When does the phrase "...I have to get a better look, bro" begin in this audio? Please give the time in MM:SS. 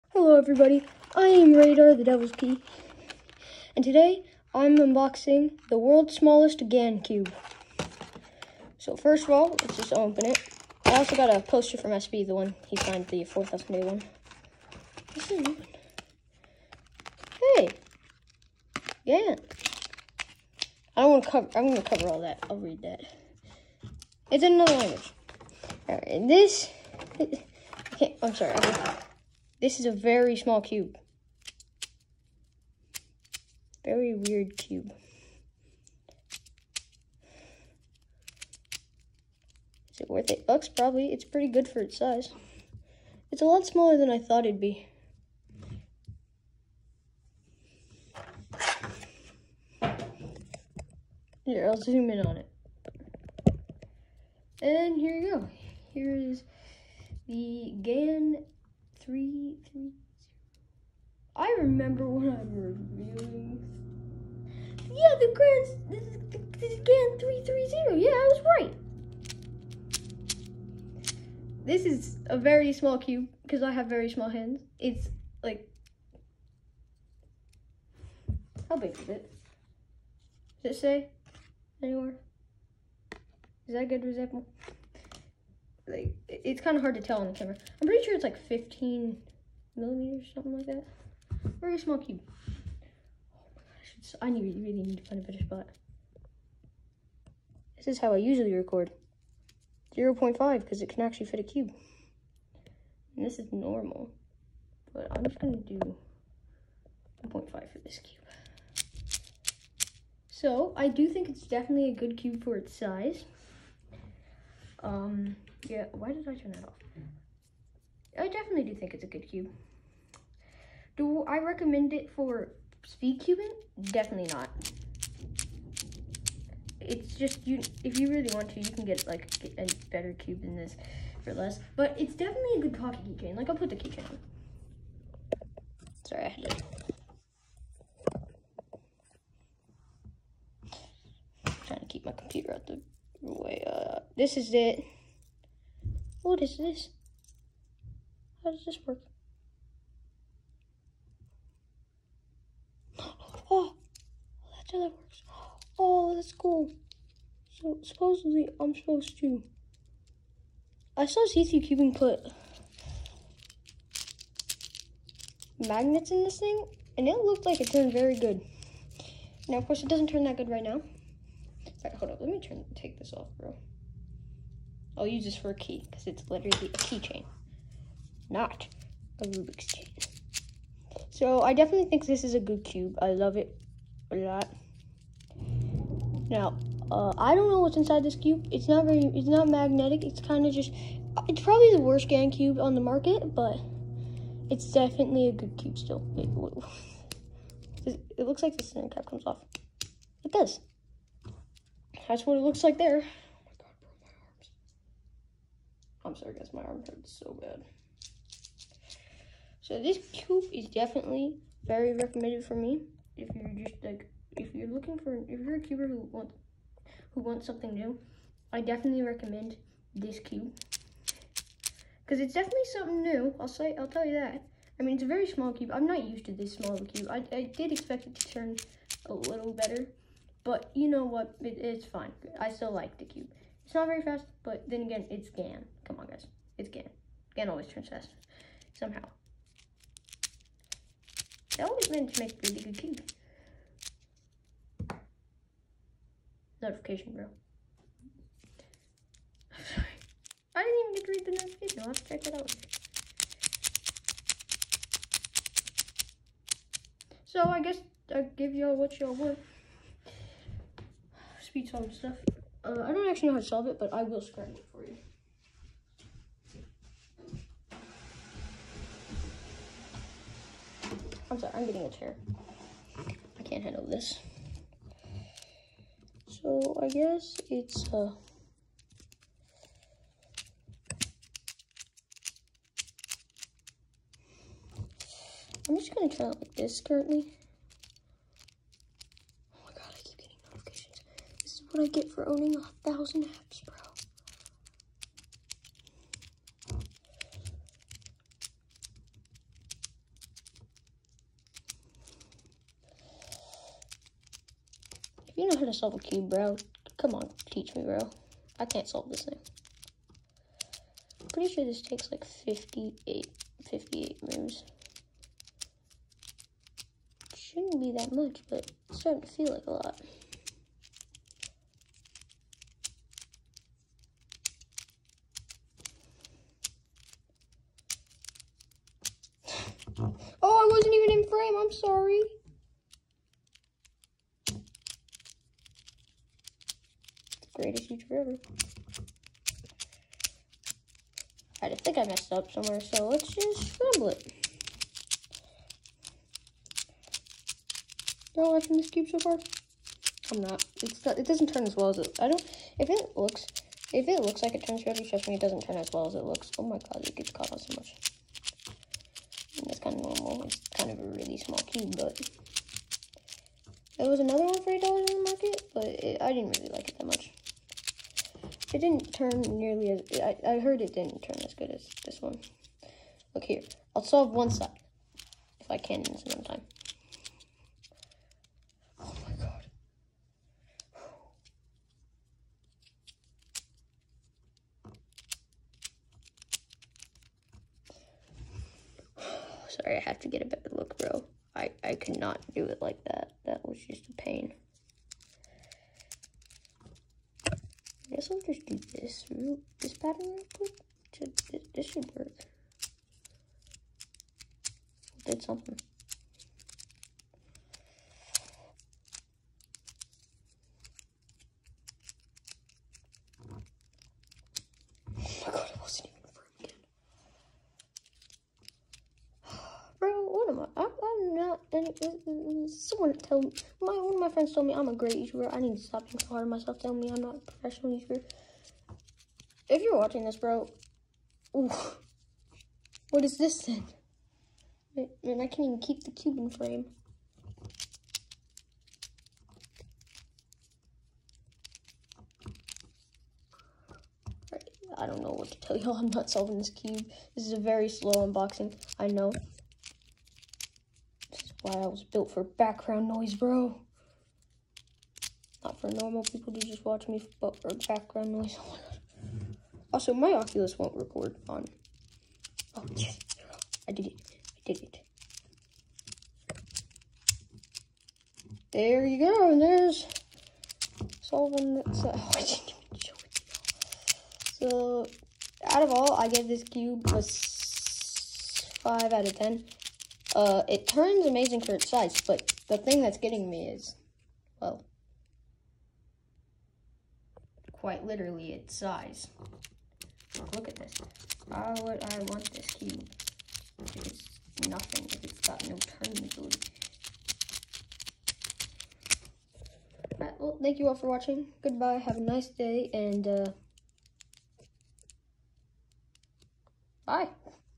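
06:29.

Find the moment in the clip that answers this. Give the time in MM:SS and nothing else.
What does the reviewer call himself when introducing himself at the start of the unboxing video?
00:01.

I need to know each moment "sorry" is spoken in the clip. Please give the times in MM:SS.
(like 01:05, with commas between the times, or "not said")
00:28, 02:16, 03:26, 04:09, 04:31, 06:29.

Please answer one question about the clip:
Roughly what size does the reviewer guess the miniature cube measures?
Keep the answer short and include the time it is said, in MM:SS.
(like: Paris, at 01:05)
15 millimeters, at 01:28.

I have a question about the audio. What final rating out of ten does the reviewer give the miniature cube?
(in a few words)
5 out of 10.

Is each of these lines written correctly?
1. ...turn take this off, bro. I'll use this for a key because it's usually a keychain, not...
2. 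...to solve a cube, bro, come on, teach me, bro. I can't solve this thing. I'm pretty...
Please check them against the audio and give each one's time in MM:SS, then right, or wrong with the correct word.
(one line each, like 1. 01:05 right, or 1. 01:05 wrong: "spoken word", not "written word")
1. 02:52 wrong: "literally", not "usually"
2. 05:05 right.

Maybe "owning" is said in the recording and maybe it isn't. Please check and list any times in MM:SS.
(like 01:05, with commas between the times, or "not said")
04:52.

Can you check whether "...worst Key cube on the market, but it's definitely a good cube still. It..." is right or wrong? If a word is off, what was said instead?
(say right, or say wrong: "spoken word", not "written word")
wrong: "GAN", not "Key".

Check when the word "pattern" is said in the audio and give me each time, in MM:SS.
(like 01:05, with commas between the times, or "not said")
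06:39.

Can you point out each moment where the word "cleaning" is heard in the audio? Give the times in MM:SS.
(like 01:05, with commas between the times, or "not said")
not said.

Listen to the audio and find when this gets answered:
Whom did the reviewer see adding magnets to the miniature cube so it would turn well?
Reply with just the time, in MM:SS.
02:41.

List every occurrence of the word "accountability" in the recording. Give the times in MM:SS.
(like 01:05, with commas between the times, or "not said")
not said.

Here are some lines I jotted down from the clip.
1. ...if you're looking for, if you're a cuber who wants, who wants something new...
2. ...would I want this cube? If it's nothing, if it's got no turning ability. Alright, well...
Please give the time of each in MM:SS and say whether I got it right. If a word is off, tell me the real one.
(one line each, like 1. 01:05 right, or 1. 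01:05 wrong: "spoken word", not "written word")
1. 03:34 right
2. 08:11 right.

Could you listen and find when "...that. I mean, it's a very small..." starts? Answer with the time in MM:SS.
03:44.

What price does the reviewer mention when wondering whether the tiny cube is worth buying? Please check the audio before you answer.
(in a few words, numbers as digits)
$8.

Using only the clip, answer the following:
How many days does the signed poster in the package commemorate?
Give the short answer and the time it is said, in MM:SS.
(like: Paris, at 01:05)
4,000, at 00:13.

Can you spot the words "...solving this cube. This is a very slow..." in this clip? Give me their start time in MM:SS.
07:26.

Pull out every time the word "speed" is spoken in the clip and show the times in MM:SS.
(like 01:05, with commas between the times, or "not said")
02:02, 04:21.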